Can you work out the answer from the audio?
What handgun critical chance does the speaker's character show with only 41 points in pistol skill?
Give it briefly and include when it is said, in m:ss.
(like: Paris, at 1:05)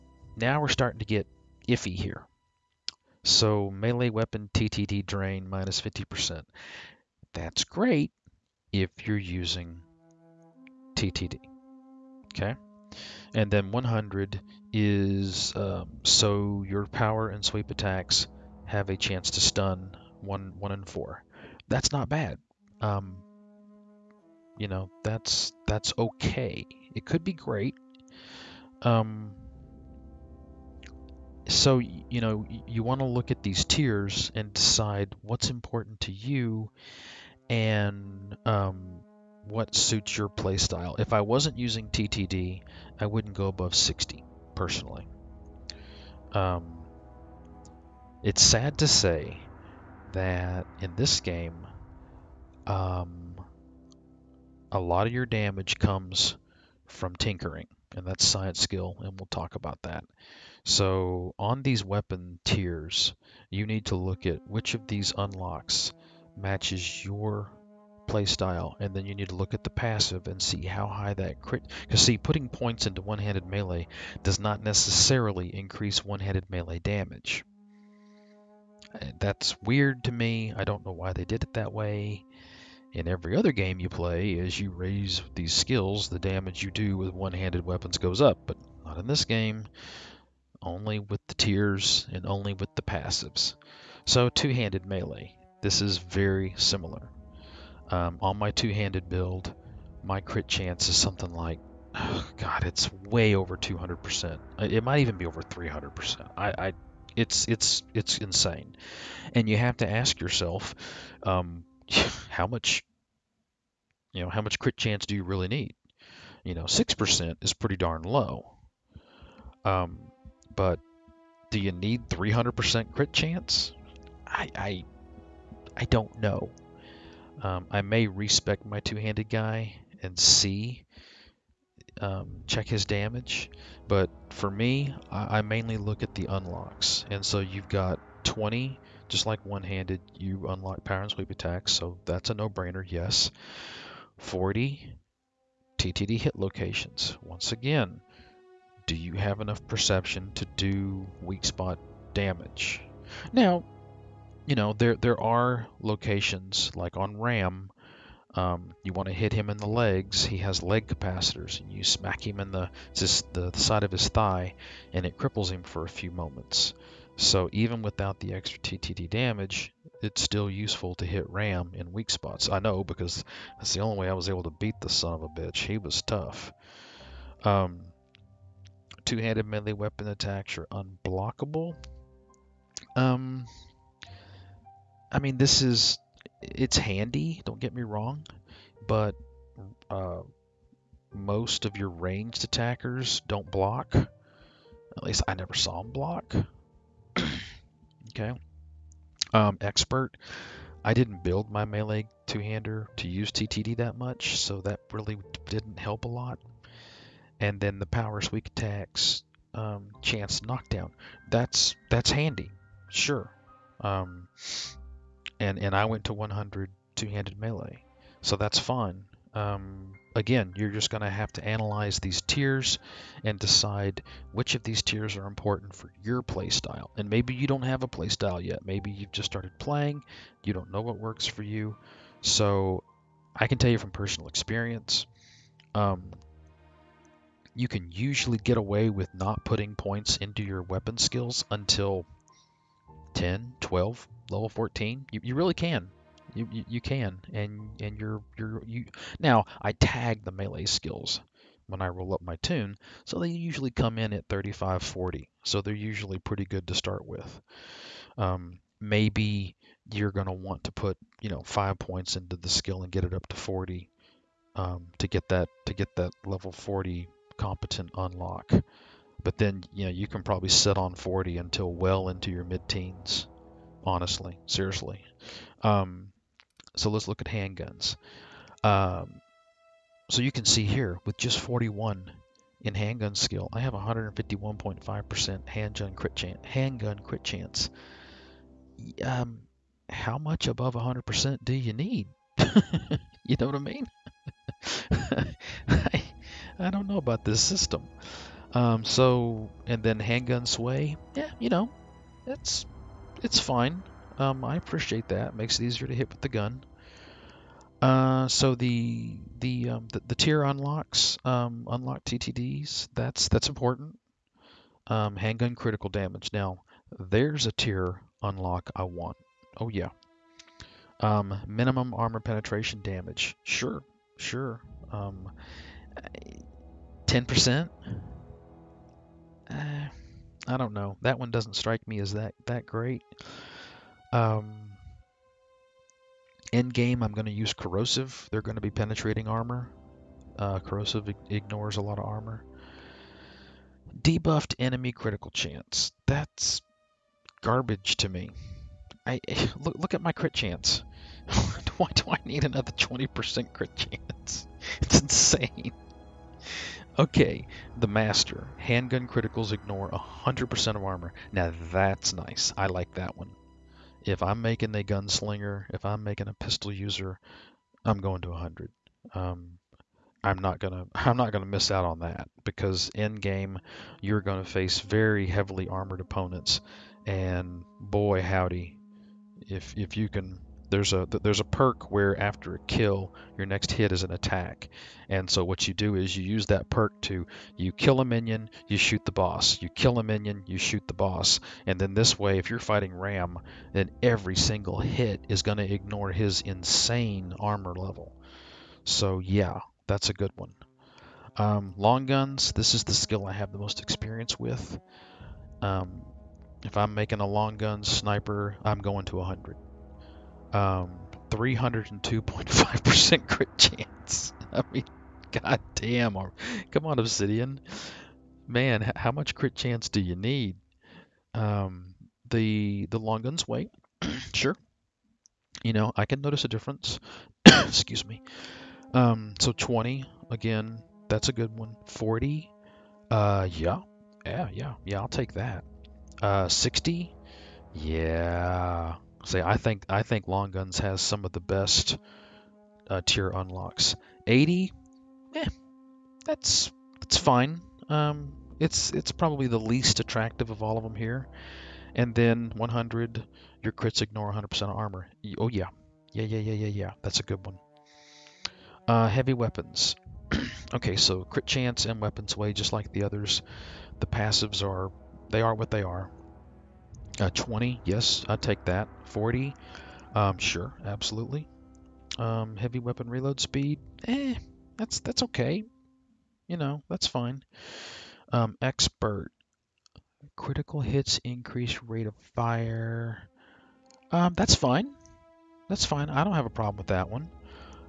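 151.5%, at 4:43.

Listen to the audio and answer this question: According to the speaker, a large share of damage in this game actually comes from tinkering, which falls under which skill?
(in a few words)
Science.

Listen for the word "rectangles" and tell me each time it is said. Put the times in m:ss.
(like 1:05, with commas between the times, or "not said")
not said.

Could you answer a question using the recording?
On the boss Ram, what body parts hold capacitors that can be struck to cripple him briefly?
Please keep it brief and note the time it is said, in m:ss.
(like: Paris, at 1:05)
Legs, at 2:40.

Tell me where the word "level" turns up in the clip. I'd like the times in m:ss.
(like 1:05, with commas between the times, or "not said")
4:04, 4:26, 6:37.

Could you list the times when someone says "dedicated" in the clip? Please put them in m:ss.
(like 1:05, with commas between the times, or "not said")
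not said.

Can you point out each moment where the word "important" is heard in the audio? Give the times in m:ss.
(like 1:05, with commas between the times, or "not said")
0:35, 3:45, 5:13.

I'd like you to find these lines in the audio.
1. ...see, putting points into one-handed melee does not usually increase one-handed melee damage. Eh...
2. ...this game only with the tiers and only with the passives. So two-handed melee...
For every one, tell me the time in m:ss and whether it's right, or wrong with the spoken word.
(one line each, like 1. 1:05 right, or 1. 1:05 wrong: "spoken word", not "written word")
1. 1:12 wrong: "necessarily", not "usually"
2. 1:29 right.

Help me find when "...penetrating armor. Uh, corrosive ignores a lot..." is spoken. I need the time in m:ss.
5:38.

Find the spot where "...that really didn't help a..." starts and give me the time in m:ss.
3:24.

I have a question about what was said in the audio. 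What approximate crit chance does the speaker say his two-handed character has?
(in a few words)
300%.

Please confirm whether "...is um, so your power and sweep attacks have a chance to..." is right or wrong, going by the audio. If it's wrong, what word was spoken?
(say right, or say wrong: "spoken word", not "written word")
right.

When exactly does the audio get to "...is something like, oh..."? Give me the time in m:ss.
1:40.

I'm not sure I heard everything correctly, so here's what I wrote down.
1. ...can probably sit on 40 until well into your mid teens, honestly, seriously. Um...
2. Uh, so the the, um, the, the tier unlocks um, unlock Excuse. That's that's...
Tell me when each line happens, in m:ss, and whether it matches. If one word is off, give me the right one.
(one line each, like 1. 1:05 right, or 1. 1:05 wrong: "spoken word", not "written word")
1. 4:30 right
2. 5:07 wrong: "TTDs", not "Excuse".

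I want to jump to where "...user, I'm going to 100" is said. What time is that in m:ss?
6:06.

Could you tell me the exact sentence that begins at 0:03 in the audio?
So melee weapon TTD drain minus 50%.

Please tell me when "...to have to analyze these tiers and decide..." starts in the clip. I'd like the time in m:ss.
3:41.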